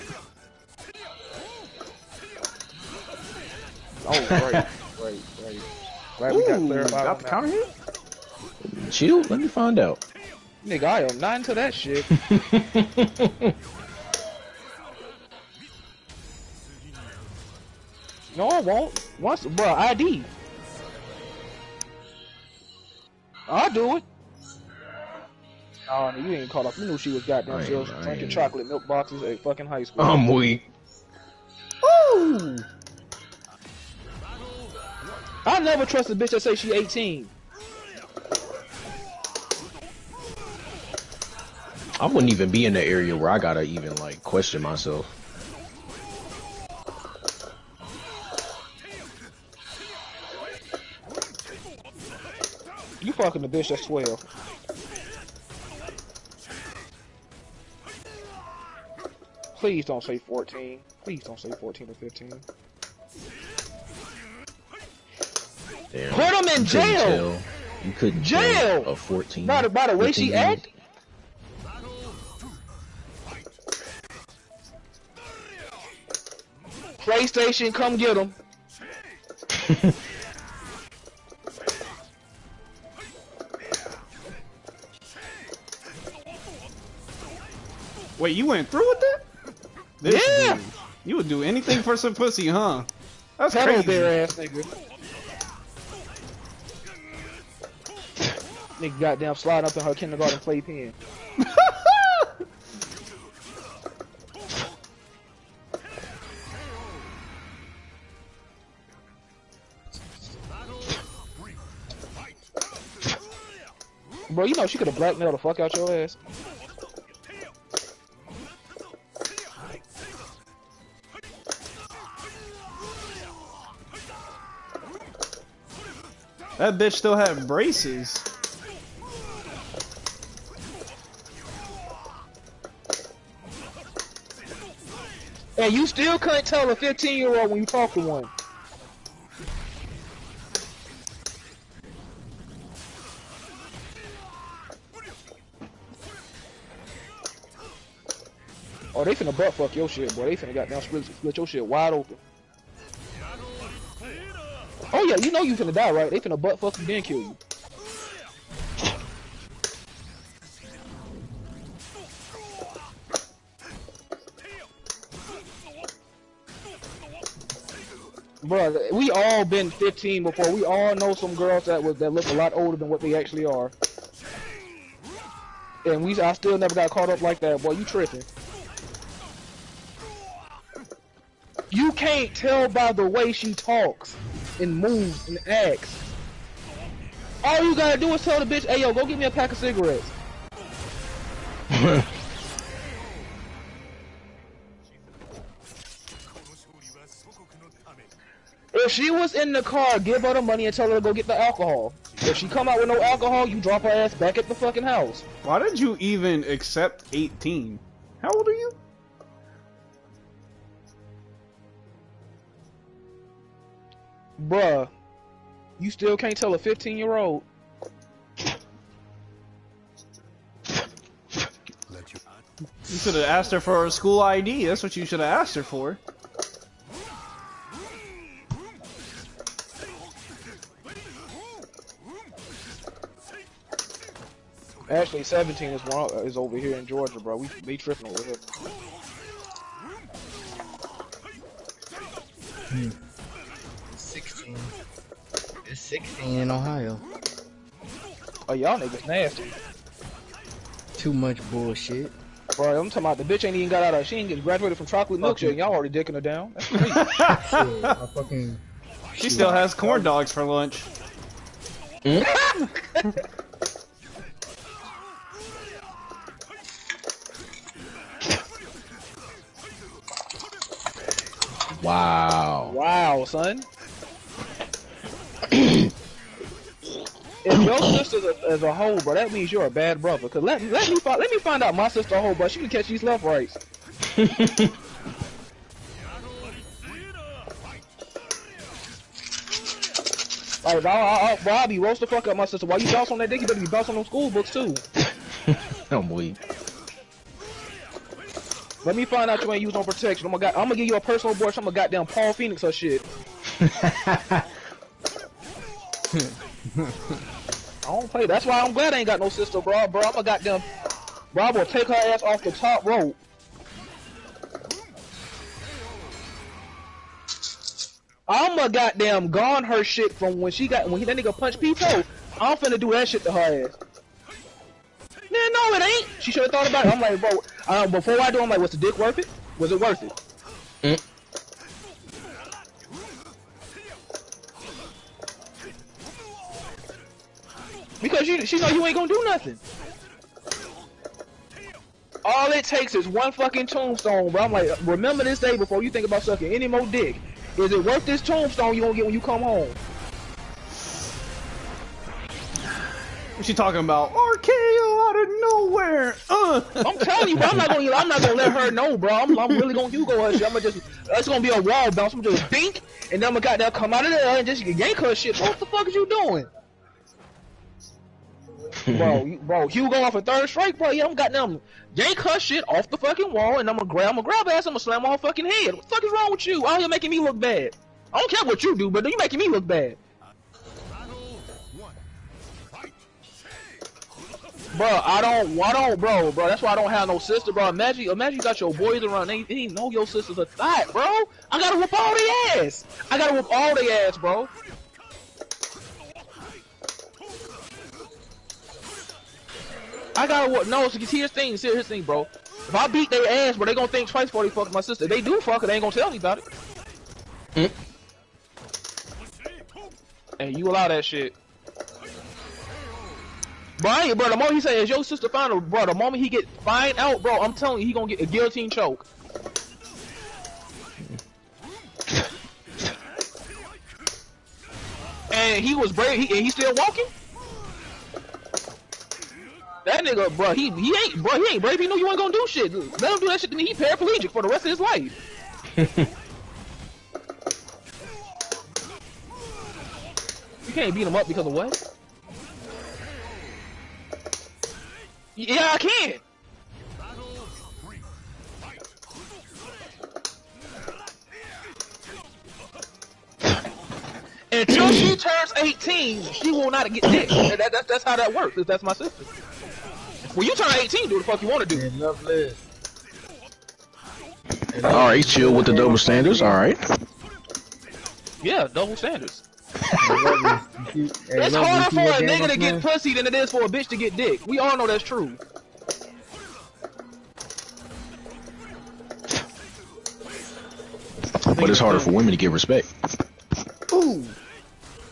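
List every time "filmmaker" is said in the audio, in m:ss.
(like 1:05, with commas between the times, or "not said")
not said.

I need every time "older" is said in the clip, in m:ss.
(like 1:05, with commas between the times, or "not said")
2:52.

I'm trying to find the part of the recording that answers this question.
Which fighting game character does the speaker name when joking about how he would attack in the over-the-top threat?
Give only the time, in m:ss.
5:02.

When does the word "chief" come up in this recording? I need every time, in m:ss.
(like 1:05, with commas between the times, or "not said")
not said.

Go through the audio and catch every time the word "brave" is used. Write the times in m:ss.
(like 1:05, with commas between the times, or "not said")
7:05, 7:11.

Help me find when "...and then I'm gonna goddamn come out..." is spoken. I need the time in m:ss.
6:03.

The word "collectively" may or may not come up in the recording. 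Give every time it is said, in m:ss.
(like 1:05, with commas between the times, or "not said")
not said.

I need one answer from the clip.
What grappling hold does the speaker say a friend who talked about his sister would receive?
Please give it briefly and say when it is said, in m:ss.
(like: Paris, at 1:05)
guillotine choke, at 6:58.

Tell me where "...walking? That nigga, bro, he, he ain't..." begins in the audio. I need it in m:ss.
7:06.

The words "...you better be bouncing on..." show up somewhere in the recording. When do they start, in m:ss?
4:53.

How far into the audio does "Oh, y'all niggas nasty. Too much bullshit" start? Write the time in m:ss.
4:08.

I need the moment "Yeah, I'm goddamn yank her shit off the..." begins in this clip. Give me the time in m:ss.
6:10.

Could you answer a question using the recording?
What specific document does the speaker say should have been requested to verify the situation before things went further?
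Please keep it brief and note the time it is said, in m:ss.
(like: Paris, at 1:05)
school ID, at 3:43.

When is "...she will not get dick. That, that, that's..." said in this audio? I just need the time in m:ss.
7:36.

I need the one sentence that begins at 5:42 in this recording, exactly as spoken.
All it takes is one fucking tombstone, bro.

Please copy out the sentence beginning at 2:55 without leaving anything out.
And we, I still never got caught up like that.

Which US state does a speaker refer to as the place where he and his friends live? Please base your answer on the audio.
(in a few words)
Georgia.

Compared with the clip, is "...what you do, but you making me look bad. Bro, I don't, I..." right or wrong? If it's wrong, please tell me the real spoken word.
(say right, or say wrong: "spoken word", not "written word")
right.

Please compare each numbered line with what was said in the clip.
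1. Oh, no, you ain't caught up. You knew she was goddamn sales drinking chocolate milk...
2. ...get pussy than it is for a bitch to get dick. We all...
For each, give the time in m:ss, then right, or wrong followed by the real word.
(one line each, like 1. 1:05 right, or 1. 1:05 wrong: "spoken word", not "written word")
1. 0:25 right
2. 7:52 right.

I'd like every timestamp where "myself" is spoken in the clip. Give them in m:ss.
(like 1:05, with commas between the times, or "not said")
0:44.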